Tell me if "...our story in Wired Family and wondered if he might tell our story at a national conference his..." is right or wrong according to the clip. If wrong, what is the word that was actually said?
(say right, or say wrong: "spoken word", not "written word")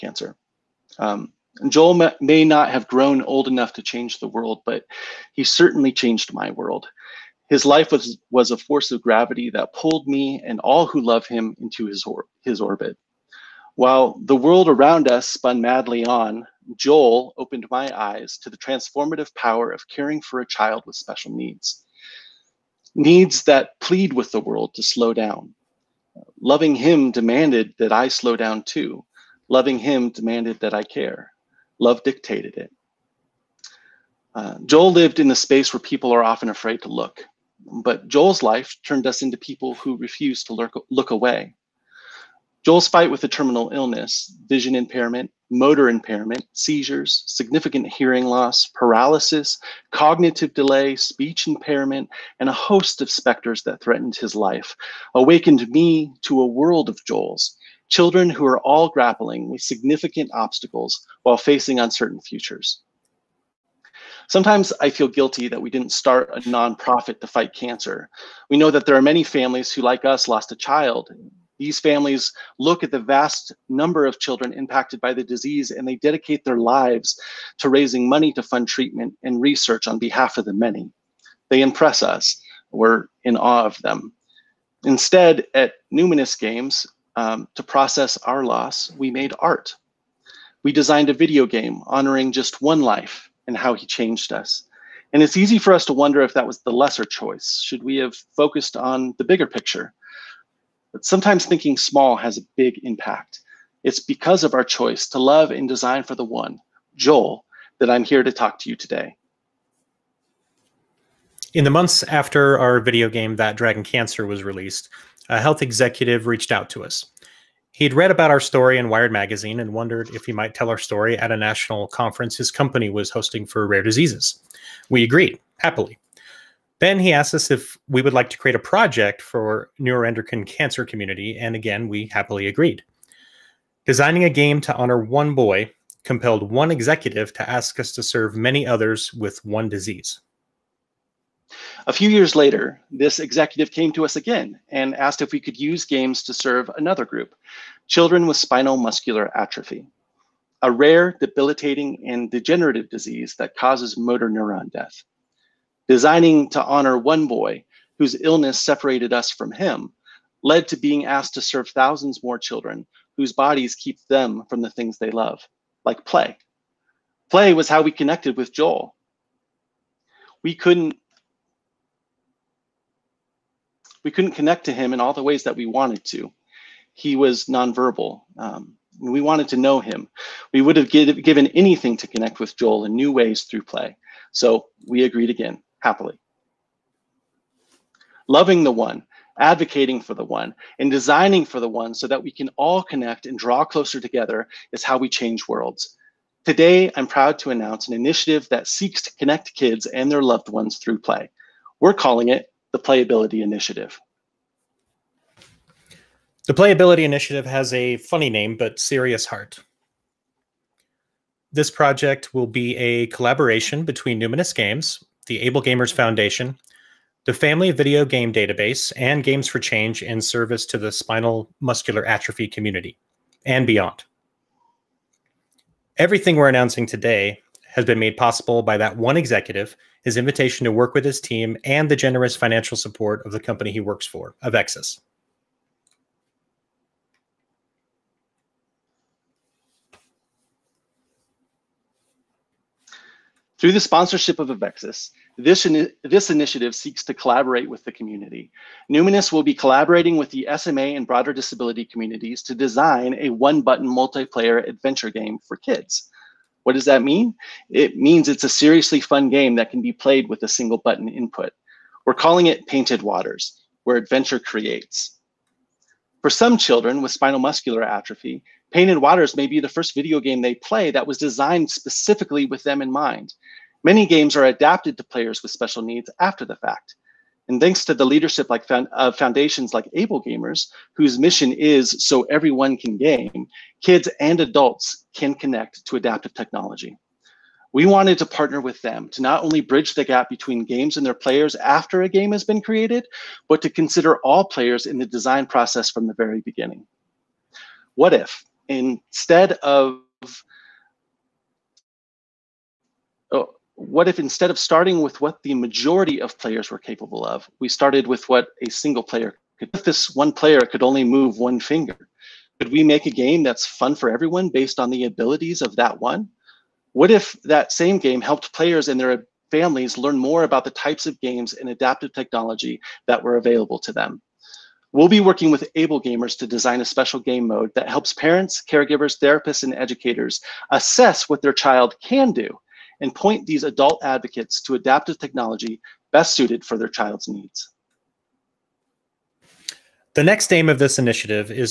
wrong: "Magazine", not "Family".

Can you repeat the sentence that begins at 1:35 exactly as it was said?
And it's easy for us to wonder if that was the lesser choice.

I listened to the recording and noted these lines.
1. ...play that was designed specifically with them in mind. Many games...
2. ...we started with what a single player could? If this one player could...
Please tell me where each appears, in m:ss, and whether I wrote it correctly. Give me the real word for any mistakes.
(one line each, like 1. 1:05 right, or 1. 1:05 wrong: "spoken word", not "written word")
1. 4:30 right
2. 5:07 right.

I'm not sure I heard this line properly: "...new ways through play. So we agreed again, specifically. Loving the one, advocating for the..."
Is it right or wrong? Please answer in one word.
wrong.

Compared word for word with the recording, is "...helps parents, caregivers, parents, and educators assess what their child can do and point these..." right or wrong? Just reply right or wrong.
wrong.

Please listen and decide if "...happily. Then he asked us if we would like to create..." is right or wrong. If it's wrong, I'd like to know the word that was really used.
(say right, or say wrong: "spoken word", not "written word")
right.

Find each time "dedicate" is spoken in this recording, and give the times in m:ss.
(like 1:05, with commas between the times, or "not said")
1:15.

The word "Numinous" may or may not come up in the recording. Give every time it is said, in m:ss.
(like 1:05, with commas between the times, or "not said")
1:25, 3:34, 4:08.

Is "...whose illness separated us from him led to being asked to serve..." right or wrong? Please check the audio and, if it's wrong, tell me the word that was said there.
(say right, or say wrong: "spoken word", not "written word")
right.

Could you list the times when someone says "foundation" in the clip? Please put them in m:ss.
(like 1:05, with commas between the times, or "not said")
3:35, 4:39.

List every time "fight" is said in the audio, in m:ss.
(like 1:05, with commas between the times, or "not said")
0:42, 1:07.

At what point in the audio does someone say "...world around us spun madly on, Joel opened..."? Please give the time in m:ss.
0:14.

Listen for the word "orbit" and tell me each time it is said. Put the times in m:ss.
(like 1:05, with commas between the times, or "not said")
0:12.